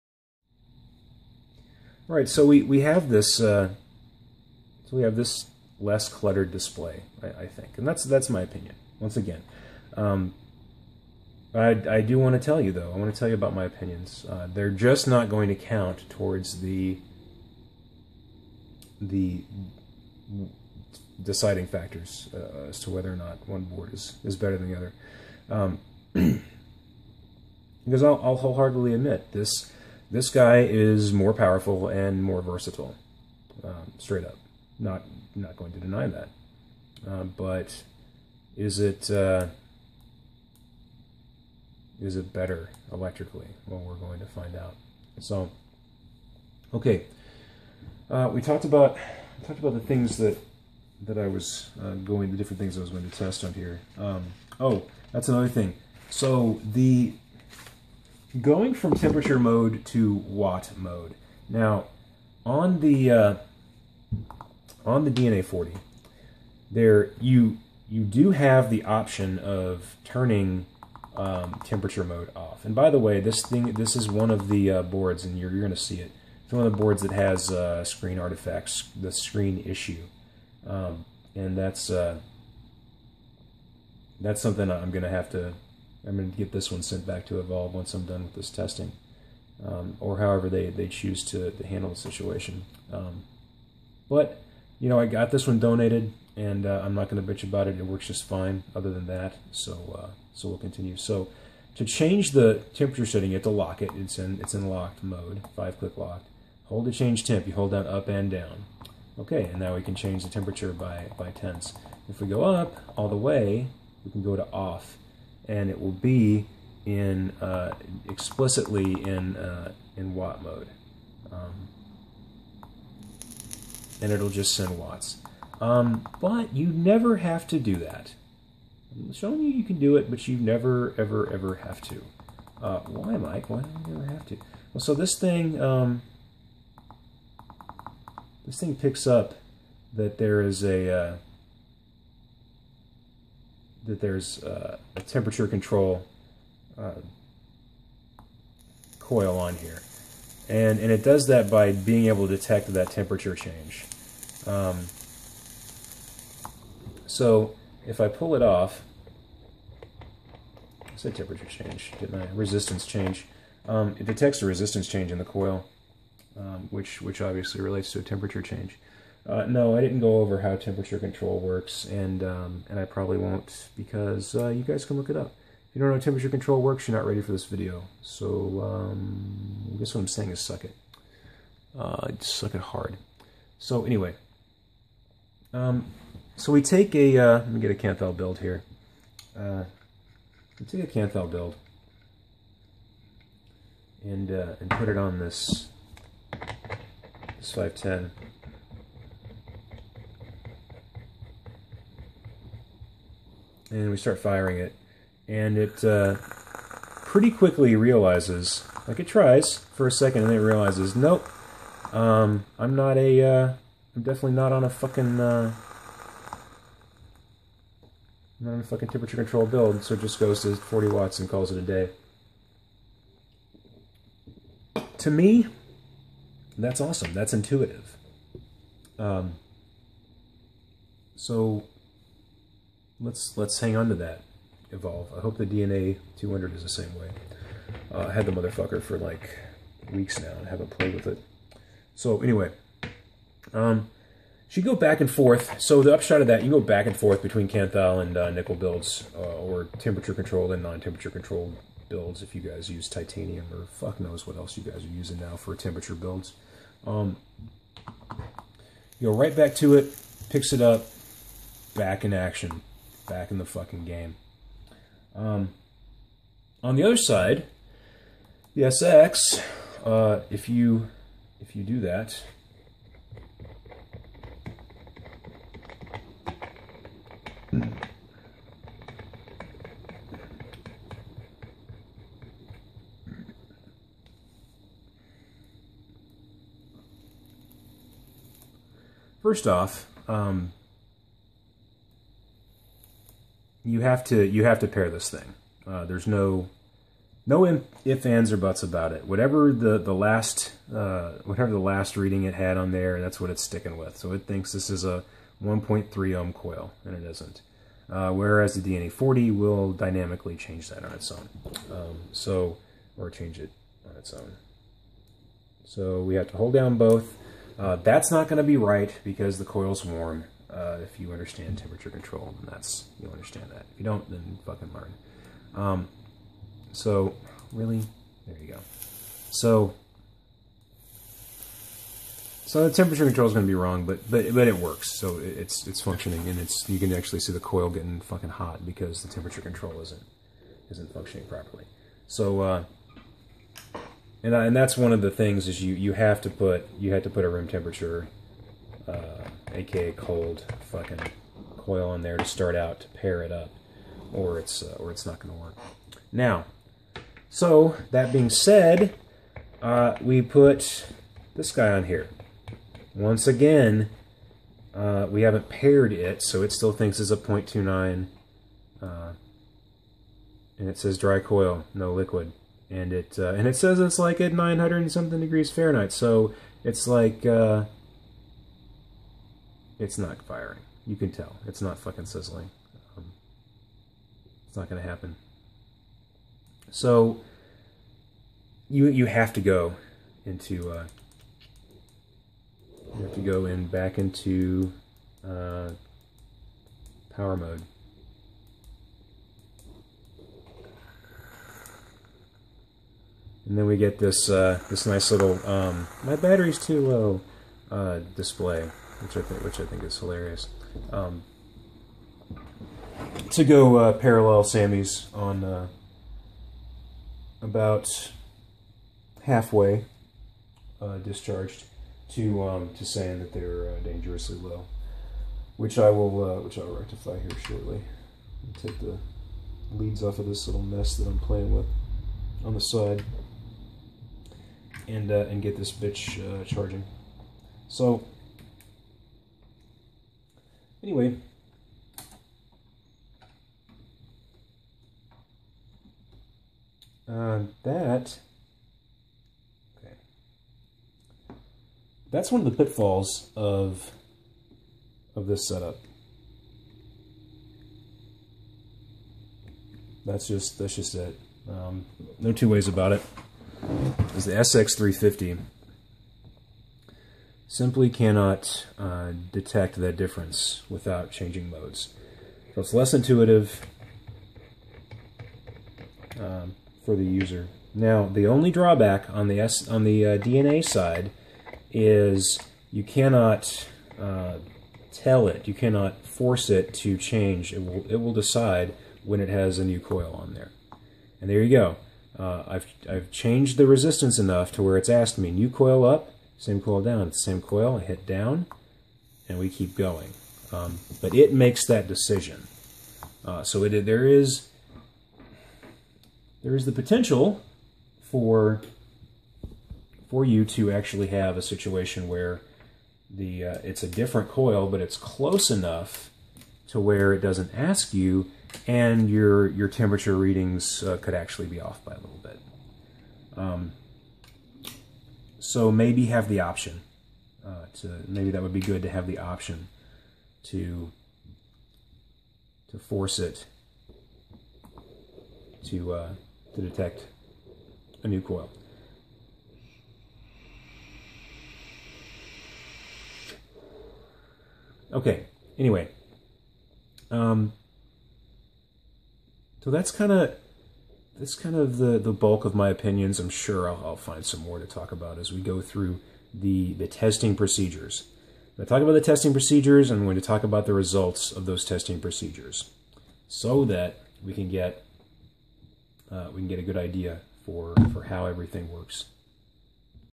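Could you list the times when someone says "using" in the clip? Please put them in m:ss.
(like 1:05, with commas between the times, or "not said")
4:14.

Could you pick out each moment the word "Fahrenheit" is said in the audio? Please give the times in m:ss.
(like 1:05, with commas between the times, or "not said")
6:15.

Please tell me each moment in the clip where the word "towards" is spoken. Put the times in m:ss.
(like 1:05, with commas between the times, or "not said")
0:16.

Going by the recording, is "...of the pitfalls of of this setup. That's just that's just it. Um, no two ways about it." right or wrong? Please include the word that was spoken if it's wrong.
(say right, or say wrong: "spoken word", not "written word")
right.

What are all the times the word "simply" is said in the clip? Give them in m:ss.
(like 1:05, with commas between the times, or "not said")
7:47.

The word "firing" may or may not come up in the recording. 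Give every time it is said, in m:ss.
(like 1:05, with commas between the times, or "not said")
3:24, 6:20.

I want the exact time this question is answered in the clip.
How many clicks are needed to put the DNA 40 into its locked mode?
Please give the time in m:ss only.
1:45.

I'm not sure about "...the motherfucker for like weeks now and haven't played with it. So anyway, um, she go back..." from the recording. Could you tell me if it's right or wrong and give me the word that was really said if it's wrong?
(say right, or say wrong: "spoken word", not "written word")
right.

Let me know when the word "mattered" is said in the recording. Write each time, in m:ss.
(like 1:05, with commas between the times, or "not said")
not said.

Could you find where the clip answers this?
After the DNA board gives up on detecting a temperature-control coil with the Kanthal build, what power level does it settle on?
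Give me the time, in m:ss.
3:40.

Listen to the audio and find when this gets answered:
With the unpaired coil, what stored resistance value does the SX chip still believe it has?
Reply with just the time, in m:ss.
6:07.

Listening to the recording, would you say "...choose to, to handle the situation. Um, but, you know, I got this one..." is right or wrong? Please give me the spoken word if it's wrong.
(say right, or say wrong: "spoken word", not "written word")
right.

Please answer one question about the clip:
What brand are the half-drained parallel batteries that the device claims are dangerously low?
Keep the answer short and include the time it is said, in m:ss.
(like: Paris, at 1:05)
Sammy's, at 6:54.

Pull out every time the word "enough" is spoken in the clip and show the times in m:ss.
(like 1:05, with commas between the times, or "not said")
8:14, 8:35.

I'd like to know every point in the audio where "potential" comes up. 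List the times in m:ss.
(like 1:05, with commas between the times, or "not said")
8:26.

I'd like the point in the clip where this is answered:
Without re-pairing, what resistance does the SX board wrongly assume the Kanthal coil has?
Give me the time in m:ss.
5:05.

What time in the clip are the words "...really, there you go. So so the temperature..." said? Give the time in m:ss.
5:27.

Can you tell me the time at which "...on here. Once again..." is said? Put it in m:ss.
6:01.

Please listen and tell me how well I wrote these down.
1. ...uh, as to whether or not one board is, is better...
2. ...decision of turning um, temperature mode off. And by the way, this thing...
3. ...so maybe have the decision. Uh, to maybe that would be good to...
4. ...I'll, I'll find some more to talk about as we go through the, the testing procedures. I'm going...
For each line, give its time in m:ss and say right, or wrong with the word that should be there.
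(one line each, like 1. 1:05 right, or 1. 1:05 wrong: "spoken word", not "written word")
1. 0:22 right
2. 1:08 wrong: "option", not "decision"
3. 8:45 wrong: "option", not "decision"
4. 9:13 right.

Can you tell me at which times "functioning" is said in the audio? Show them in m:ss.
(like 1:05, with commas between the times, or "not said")
5:35, 5:40.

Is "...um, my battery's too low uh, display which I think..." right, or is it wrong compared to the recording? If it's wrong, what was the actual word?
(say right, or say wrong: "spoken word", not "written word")
right.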